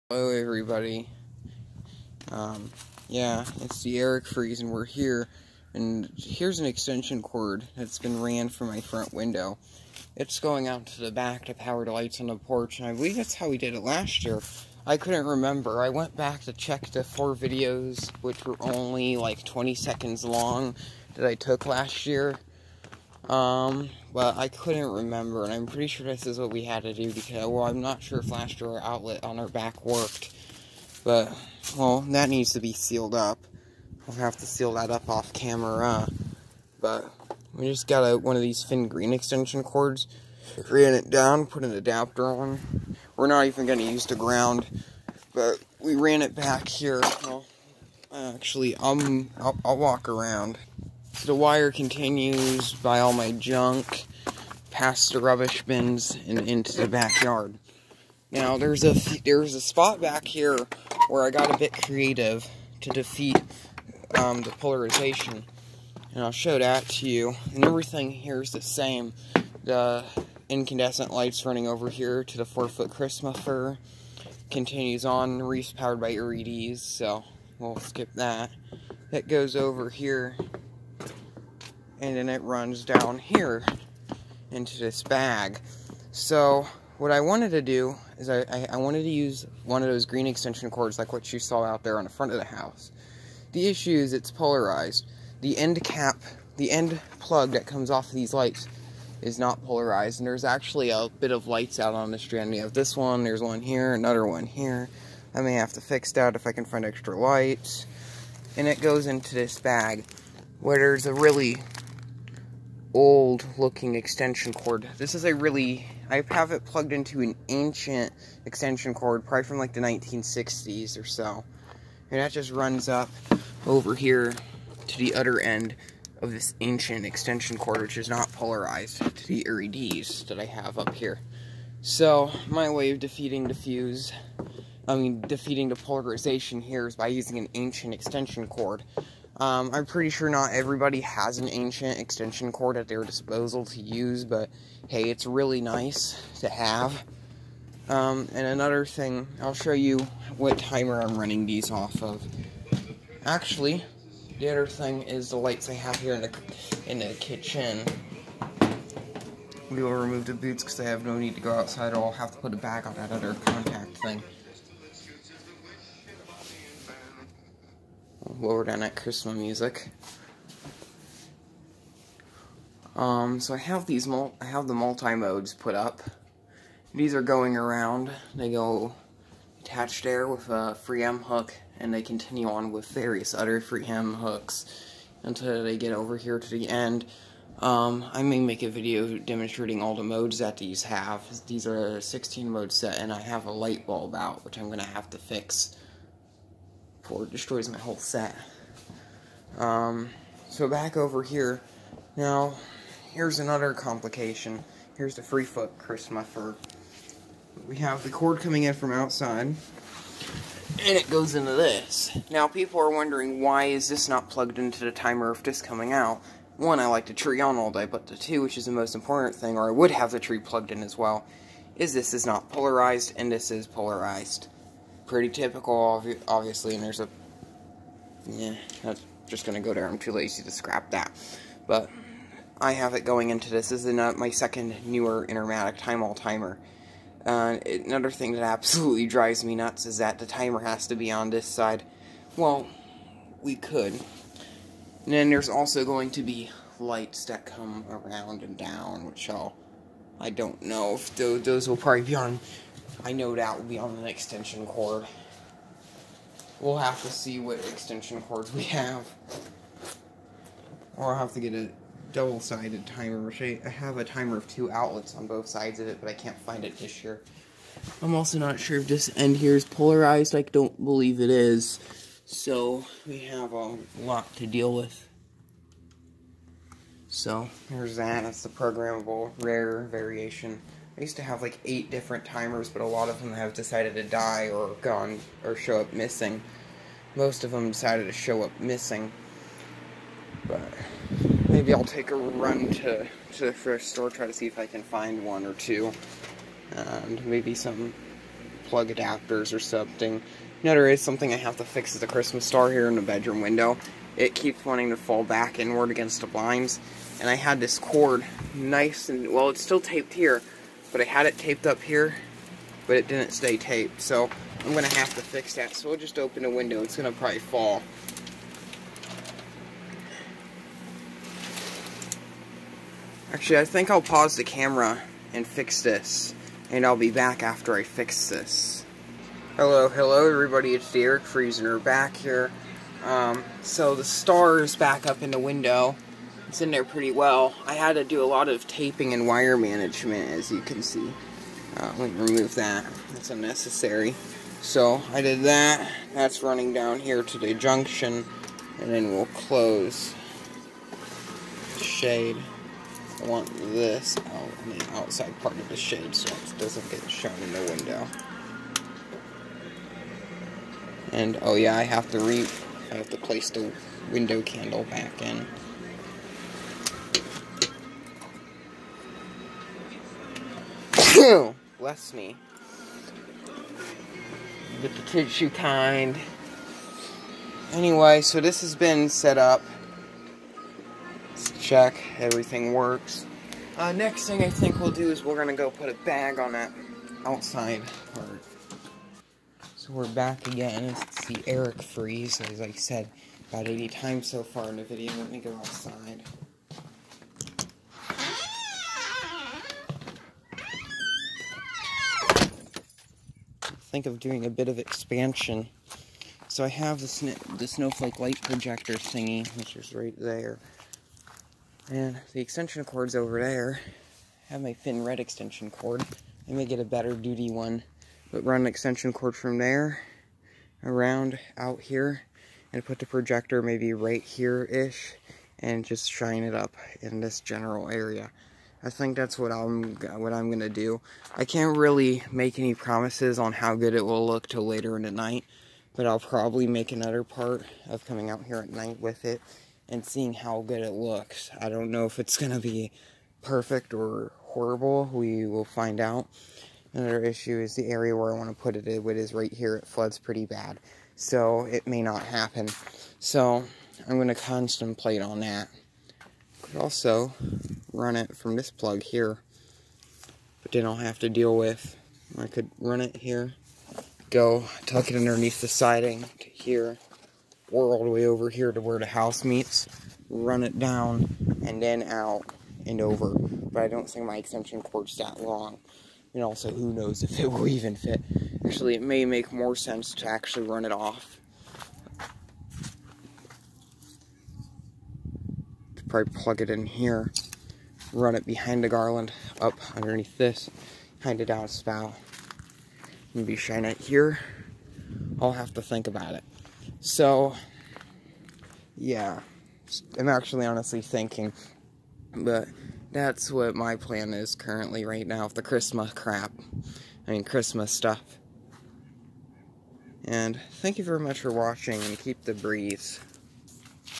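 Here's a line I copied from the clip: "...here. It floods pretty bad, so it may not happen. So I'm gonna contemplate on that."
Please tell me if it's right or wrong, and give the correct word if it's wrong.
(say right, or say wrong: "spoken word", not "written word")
right.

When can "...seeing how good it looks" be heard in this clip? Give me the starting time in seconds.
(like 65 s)
440 s.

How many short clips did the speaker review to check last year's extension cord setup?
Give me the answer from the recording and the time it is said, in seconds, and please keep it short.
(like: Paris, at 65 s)
4, at 17 s.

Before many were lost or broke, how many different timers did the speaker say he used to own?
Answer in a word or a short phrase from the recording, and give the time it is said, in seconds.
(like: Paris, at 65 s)
8, at 281 s.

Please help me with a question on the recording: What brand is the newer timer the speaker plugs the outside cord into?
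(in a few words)
Intermatic.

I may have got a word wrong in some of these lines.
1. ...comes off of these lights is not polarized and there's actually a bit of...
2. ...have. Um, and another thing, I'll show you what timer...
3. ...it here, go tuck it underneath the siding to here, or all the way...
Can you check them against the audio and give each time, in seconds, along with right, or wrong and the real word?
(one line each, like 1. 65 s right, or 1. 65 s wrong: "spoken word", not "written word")
1. 97 s right
2. 146 s right
3. 463 s right.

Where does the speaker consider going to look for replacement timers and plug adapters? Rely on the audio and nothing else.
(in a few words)
thrift store.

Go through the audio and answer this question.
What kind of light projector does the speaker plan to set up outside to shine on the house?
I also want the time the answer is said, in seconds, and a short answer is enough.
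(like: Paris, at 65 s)
snowflake, at 407 s.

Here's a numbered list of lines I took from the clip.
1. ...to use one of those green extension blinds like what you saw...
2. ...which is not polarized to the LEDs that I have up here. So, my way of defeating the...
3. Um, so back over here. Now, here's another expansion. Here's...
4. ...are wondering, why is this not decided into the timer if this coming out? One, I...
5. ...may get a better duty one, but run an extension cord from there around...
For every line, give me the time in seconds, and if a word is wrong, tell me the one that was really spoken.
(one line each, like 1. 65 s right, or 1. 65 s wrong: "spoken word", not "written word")
1. 89 s wrong: "cords", not "blinds"
2. 127 s right
3. 199 s wrong: "complication", not "expansion"
4. 212 s wrong: "plugged", not "decided"
5. 416 s right.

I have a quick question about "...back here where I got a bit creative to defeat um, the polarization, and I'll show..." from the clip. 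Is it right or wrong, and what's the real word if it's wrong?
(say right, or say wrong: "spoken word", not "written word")
right.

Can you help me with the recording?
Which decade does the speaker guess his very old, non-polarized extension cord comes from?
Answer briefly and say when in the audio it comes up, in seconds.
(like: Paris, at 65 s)
1960s, at 119 s.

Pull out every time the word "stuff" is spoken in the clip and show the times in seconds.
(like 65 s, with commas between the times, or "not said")
507 s.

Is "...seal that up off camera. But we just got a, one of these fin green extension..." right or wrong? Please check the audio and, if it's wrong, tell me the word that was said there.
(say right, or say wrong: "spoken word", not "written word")
right.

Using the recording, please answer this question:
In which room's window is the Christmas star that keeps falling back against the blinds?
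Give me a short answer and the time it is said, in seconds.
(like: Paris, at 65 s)
bedroom, at 303 s.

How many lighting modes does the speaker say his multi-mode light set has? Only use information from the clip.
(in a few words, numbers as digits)
16.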